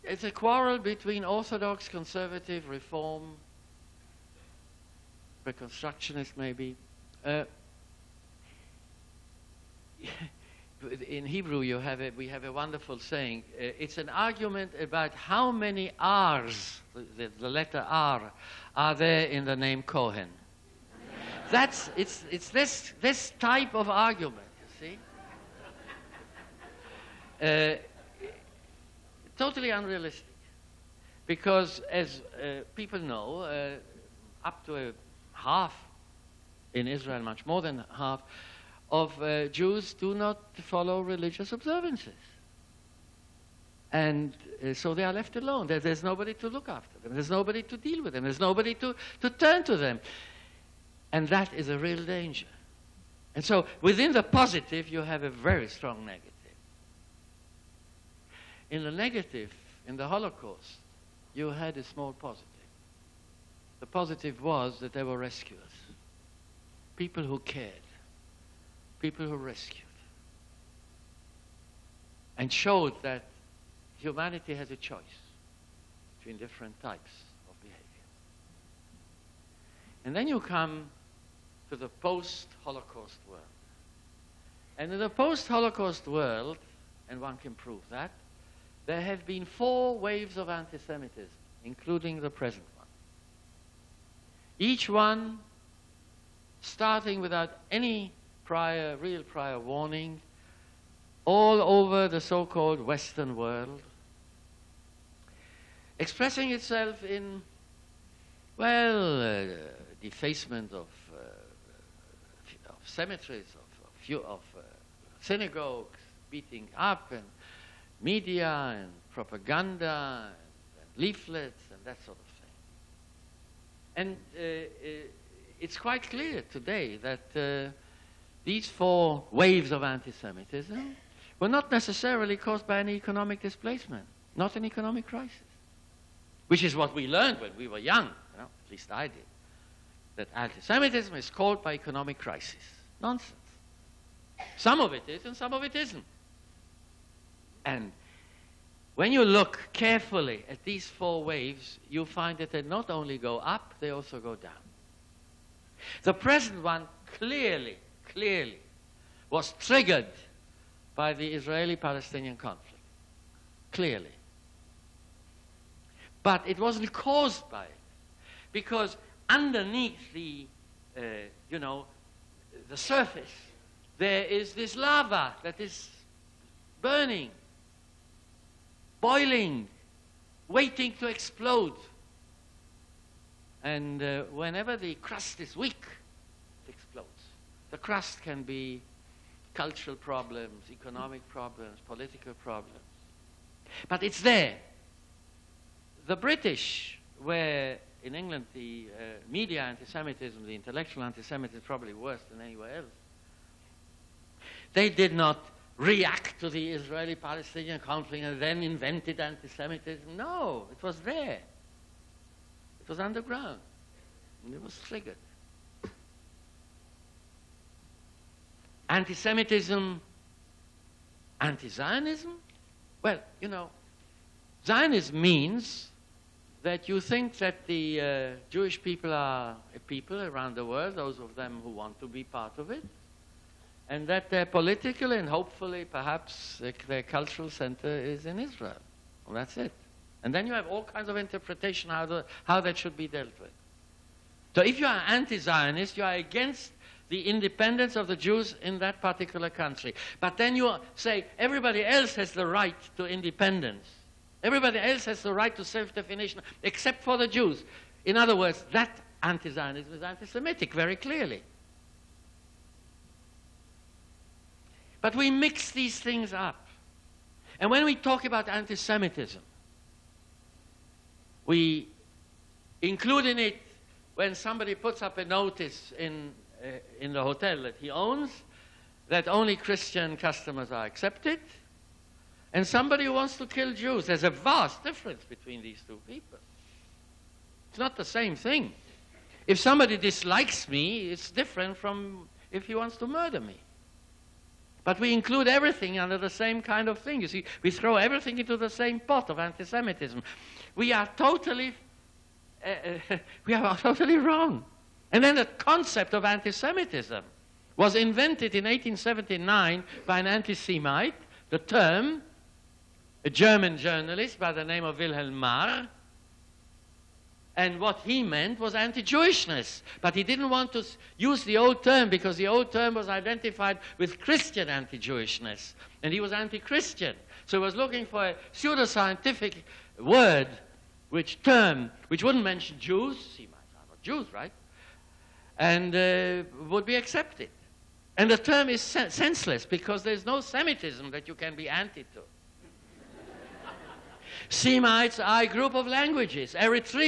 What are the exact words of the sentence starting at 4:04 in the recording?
So if you are anti-Zionist, you are against the independence of the Jews in that particular country.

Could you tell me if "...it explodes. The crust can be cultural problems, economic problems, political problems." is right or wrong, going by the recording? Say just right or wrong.
right.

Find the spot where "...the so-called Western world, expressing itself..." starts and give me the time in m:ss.
1:42.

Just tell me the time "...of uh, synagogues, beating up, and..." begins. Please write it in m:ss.
1:54.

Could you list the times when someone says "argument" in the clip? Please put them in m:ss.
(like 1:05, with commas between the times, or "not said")
0:14, 0:23.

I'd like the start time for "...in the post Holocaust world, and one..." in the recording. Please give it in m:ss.
1:24.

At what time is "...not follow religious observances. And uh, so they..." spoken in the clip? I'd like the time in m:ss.
0:40.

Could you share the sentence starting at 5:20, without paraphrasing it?
But he didn't want to use the old term because the old term was identified with Christian anti Jewishness.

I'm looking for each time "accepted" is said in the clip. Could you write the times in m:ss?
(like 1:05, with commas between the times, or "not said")
4:40, 5:36.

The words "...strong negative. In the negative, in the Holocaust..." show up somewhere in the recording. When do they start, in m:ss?
0:55.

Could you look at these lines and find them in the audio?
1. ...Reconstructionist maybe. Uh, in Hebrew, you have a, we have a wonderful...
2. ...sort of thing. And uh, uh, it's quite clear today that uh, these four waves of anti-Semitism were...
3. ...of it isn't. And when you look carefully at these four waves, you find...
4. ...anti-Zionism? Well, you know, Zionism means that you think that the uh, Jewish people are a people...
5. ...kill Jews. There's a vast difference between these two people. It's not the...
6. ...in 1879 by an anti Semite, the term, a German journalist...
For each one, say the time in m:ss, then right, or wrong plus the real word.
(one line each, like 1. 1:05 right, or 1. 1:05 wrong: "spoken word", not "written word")
1. 0:05 right
2. 2:02 right
3. 2:25 right
4. 3:41 right
5. 4:43 right
6. 5:08 right.